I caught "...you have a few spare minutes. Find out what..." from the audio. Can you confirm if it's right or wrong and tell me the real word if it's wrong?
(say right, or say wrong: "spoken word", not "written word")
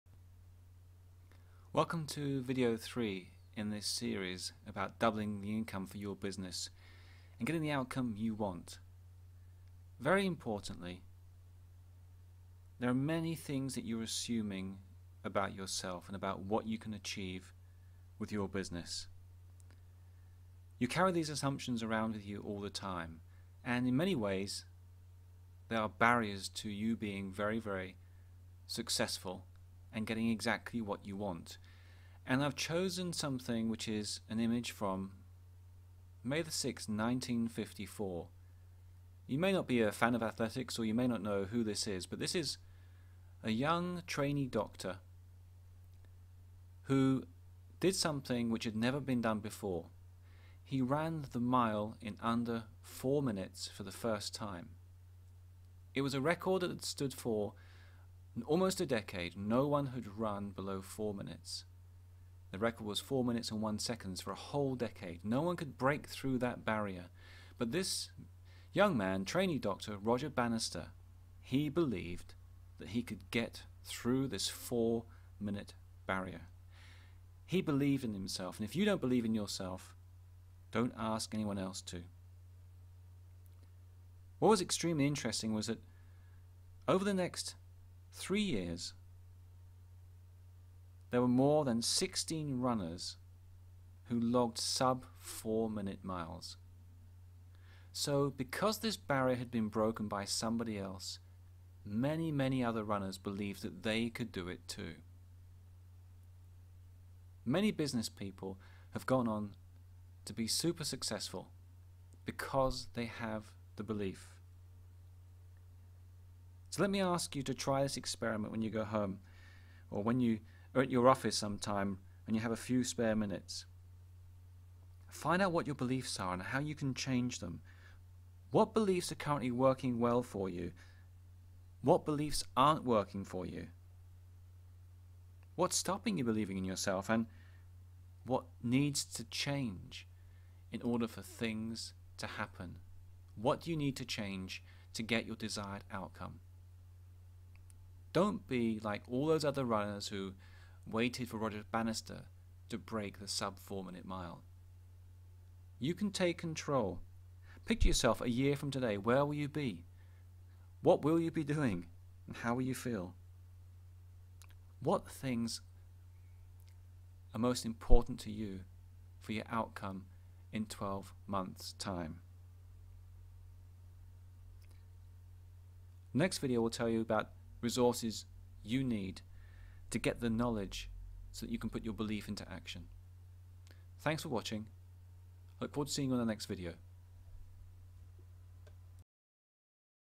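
right.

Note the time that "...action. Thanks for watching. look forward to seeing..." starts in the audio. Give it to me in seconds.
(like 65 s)
182 s.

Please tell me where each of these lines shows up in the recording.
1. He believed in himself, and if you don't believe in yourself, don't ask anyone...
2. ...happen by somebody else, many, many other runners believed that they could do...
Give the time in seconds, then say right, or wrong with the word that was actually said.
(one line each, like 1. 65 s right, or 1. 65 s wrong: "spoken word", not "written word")
1. 77 s right
2. 99 s wrong: "broken", not "happen".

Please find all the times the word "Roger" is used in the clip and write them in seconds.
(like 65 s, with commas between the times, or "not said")
69 s, 151 s.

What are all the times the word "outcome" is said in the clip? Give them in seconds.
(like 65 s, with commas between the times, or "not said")
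7 s, 145 s, 169 s.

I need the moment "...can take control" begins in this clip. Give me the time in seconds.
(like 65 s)
155 s.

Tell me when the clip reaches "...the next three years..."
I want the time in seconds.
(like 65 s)
87 s.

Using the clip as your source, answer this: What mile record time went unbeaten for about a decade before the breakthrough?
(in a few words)
4 minutes 1 second.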